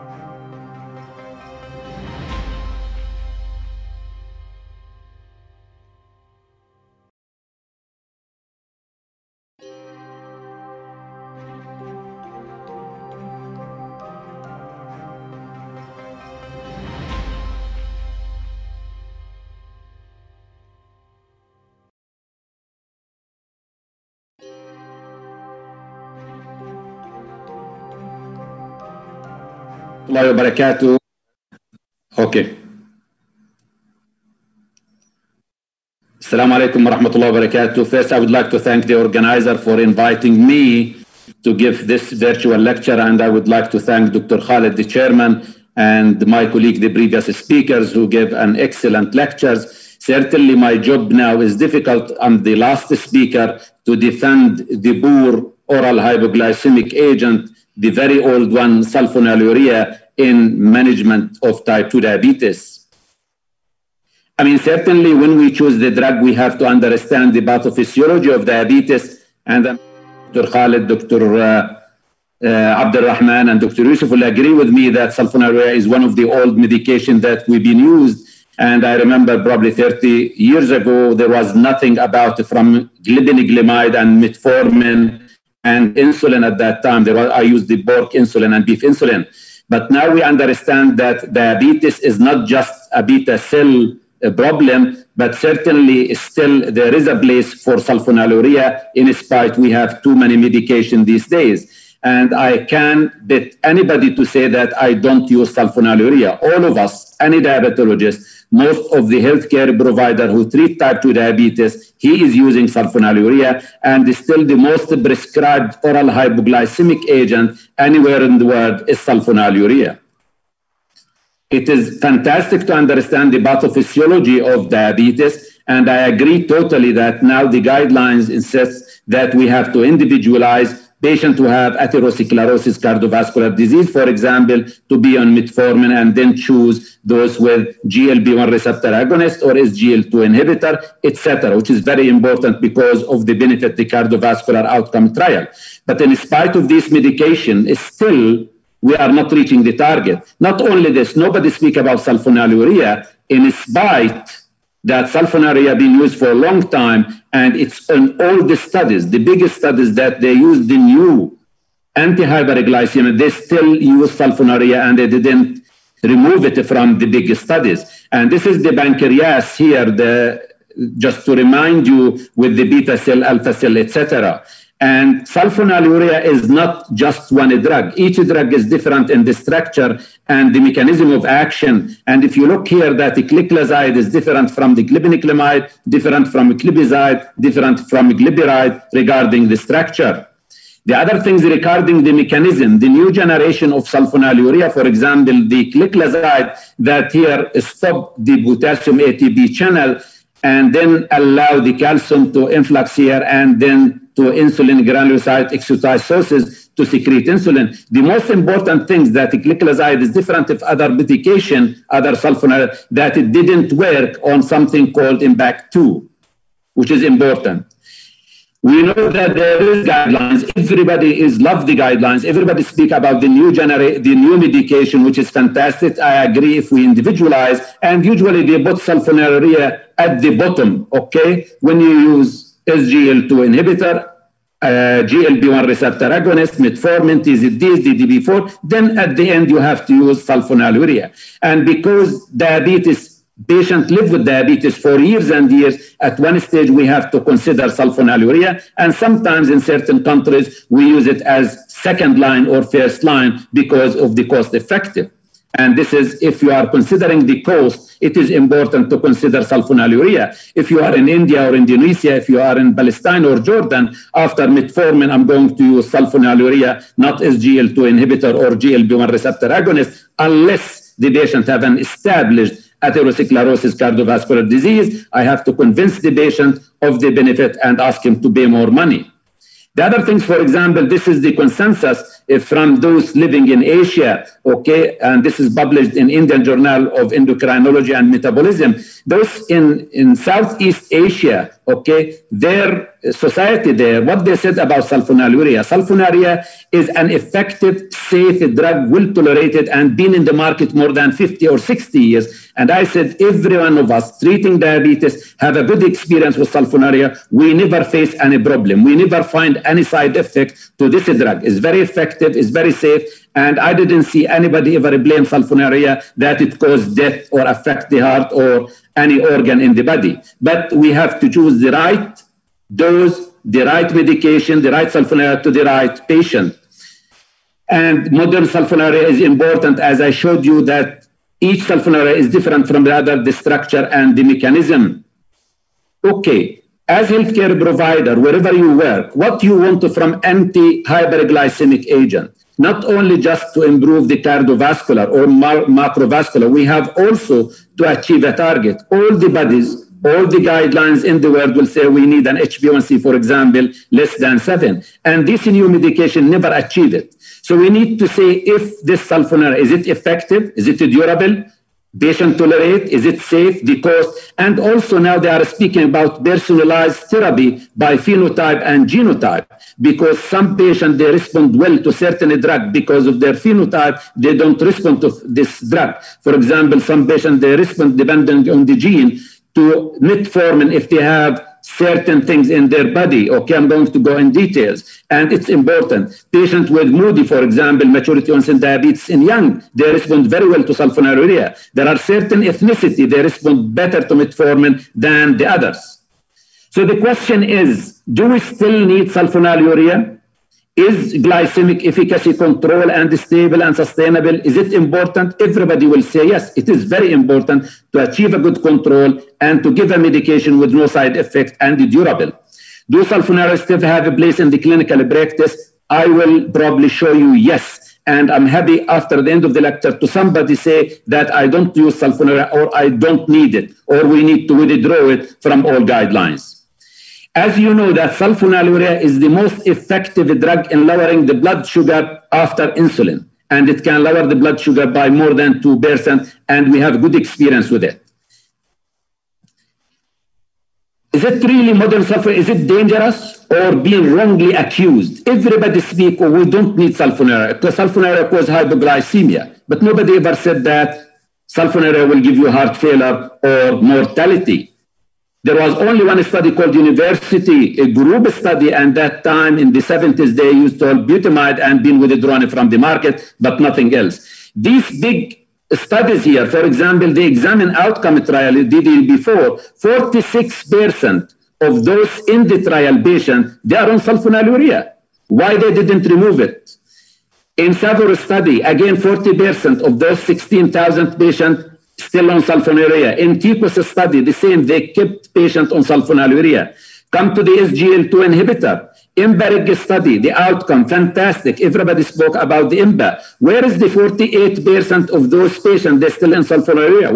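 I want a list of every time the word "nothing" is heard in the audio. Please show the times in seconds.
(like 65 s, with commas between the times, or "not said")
81 s, 463 s.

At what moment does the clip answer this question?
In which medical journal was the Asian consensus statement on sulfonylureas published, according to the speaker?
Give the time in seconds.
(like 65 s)
286 s.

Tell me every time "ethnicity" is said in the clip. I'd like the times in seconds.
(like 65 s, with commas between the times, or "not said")
392 s.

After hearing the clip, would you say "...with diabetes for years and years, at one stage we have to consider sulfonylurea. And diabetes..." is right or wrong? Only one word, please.
wrong.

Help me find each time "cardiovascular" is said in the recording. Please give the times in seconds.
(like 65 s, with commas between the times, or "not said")
132 s, 143 s, 273 s, 344 s.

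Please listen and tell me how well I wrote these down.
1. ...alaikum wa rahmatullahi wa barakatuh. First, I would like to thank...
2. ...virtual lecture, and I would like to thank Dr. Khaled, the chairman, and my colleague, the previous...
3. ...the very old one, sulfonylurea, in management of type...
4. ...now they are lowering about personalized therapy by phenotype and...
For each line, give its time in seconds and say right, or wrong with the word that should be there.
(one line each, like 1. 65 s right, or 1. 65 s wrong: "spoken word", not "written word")
1. 36 s right
2. 42 s right
3. 57 s right
4. 364 s wrong: "speaking", not "lowering".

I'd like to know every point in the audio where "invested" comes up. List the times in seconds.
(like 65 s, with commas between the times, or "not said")
not said.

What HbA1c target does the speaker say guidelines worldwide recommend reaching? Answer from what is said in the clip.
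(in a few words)
Less than 7.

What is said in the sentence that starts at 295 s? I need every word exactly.
Sulfonylurea is an effective, safe drug, well tolerated, and been in the market more than 50 or 60 years.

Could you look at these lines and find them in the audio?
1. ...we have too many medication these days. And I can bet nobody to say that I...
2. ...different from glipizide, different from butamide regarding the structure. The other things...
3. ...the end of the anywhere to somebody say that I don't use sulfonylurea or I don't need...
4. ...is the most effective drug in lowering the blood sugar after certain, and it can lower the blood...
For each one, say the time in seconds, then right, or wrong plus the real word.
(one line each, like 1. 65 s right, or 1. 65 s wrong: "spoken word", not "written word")
1. 99 s wrong: "anybody", not "nobody"
2. 185 s wrong: "glibiride", not "butamide"
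3. 419 s wrong: "lecture", not "anywhere"
4. 429 s wrong: "insulin", not "certain".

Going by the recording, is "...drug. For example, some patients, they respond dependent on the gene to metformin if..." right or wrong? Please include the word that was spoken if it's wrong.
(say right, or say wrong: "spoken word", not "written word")
right.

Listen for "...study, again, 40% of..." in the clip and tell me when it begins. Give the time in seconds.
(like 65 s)
478 s.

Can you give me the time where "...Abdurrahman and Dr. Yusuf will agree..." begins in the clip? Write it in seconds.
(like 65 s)
72 s.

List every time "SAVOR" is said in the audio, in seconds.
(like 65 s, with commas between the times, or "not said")
477 s.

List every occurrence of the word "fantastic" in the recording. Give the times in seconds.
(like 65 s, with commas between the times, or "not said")
121 s, 225 s, 490 s.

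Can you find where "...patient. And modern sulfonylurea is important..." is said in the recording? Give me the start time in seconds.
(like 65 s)
326 s.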